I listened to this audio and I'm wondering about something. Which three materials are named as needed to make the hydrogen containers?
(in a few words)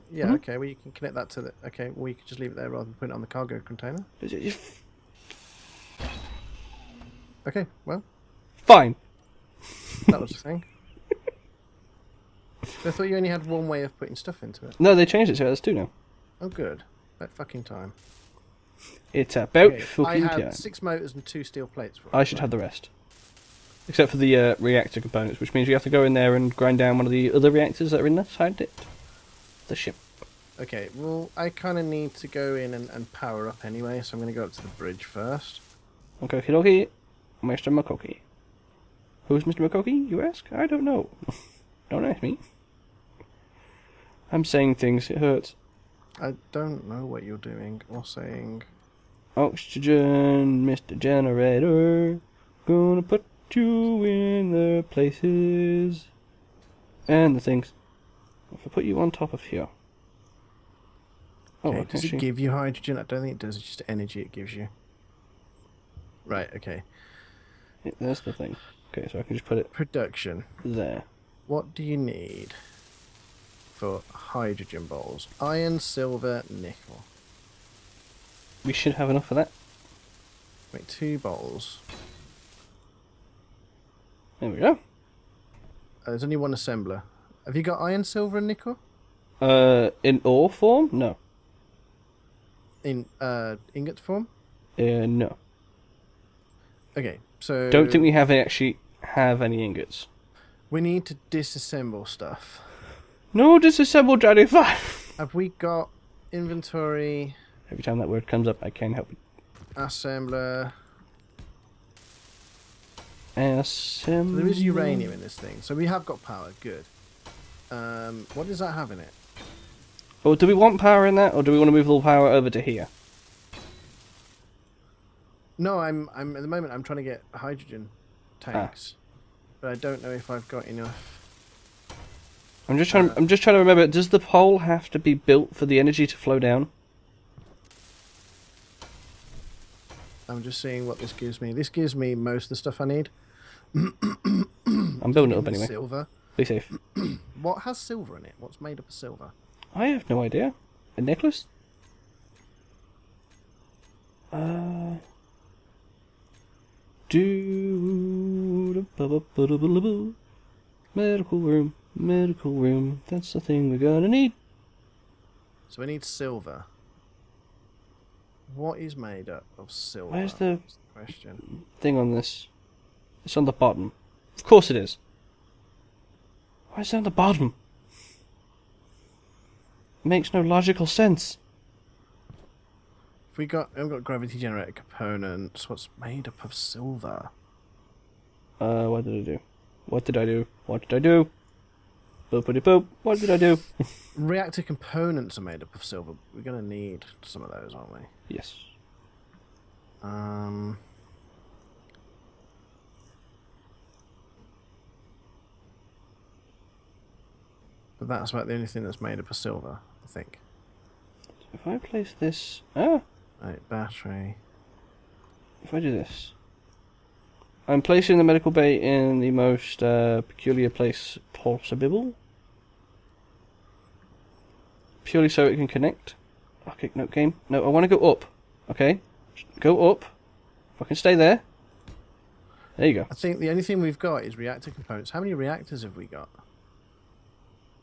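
Iron, silver, nickel.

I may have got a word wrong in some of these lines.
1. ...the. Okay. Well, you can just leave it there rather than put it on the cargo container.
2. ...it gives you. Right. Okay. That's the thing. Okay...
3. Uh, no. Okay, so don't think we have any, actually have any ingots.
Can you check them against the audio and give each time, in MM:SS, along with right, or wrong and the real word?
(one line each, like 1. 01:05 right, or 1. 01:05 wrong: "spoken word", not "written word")
1. 00:01 right
2. 01:04 right
3. 01:34 right.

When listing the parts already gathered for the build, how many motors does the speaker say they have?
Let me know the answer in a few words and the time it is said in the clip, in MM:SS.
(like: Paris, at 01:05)
6, at 00:20.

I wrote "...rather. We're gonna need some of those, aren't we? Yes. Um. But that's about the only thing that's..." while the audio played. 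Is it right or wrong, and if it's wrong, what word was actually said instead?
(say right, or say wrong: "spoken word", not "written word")
wrong: "silver", not "rather".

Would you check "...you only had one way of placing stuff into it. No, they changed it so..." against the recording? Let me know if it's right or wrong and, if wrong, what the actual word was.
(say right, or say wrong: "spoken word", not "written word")
wrong: "putting", not "placing".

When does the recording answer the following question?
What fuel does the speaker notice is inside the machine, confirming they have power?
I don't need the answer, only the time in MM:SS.
01:54.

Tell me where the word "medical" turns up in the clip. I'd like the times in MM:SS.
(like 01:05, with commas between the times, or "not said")
02:37, 02:41, 03:38.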